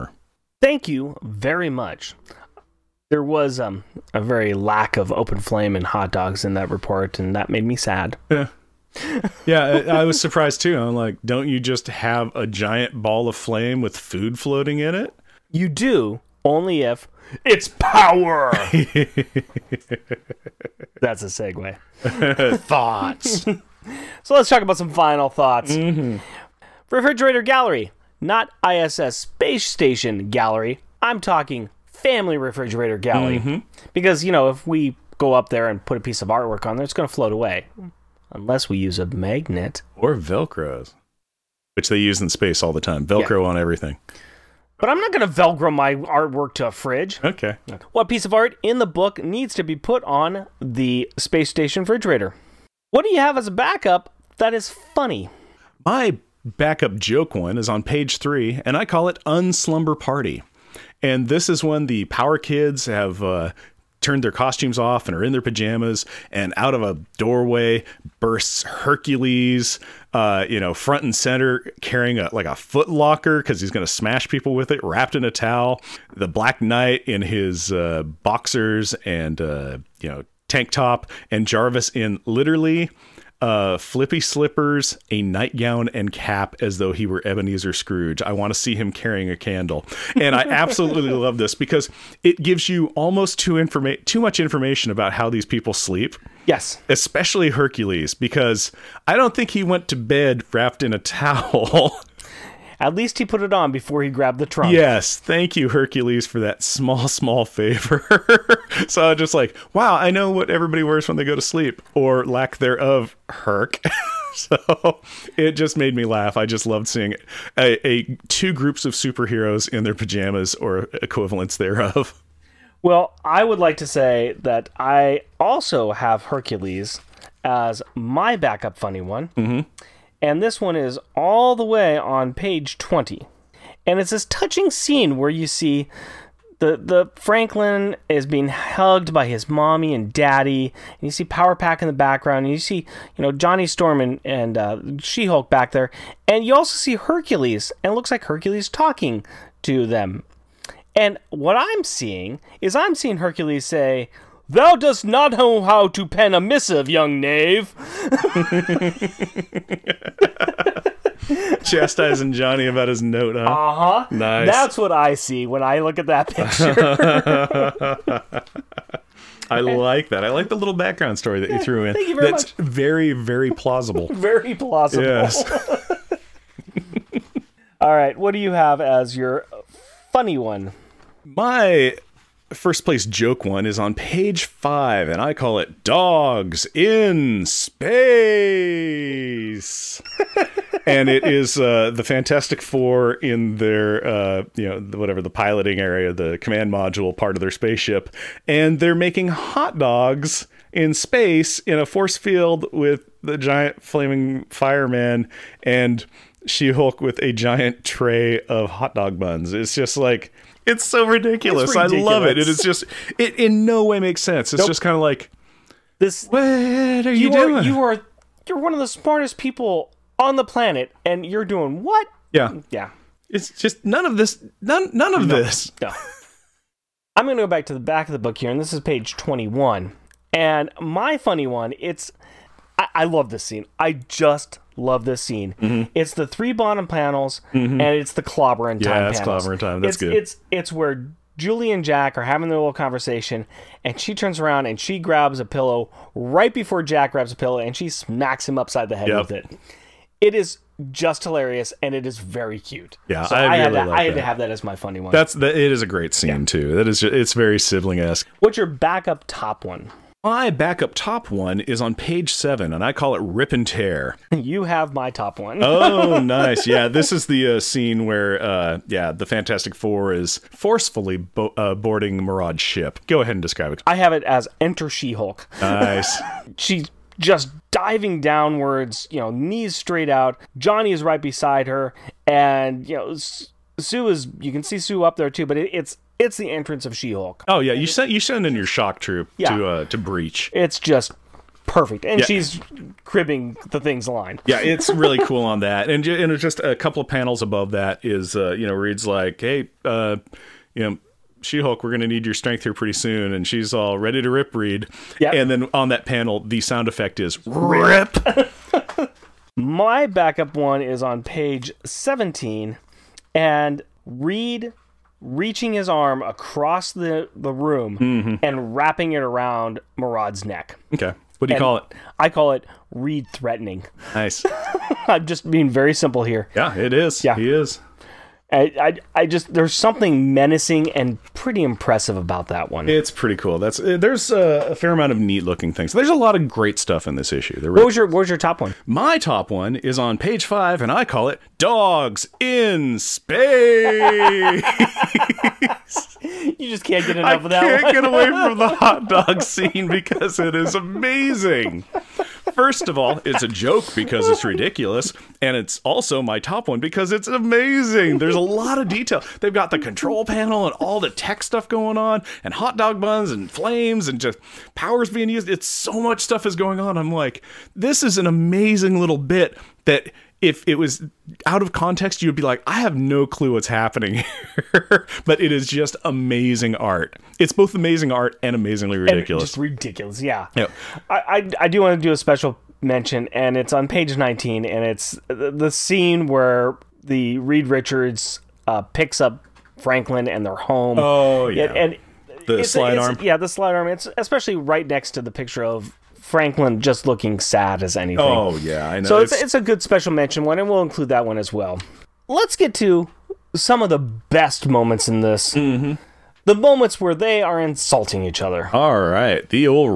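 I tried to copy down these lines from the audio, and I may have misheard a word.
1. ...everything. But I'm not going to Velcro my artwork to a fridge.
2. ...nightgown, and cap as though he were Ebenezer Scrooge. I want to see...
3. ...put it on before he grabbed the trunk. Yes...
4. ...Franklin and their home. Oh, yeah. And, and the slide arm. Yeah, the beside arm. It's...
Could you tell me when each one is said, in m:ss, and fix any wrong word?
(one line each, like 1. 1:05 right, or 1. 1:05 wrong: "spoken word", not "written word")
1. 0:43 right
2. 1:25 right
3. 1:43 right
4. 6:29 wrong: "slide", not "beside".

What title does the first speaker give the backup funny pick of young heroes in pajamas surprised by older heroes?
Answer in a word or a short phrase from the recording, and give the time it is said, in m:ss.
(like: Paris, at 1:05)
Unslumber Party, at 0:59.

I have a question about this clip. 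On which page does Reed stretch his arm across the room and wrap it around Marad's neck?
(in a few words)
Page 17.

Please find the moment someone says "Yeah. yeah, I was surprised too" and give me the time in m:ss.
0:08.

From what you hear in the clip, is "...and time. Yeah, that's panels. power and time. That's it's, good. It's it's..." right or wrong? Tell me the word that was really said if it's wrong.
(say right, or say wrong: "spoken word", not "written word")
wrong: "clobber", not "power".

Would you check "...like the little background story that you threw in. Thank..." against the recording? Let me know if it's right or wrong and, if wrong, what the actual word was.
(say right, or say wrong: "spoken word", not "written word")
right.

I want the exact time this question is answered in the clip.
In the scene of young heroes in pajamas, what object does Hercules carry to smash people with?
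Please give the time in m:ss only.
1:12.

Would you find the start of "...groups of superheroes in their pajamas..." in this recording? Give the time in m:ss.
1:58.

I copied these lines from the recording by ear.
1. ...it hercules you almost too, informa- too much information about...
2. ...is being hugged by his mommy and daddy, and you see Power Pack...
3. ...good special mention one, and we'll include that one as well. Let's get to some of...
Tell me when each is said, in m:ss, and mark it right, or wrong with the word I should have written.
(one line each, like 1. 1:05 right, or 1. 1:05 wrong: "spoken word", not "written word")
1. 1:32 wrong: "gives", not "hercules"
2. 2:18 right
3. 6:39 right.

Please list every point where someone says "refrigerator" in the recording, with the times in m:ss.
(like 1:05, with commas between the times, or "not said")
0:26, 0:32, 0:51.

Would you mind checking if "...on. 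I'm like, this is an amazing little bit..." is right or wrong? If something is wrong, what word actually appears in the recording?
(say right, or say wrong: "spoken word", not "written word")
right.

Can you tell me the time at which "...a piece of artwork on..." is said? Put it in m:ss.
0:35.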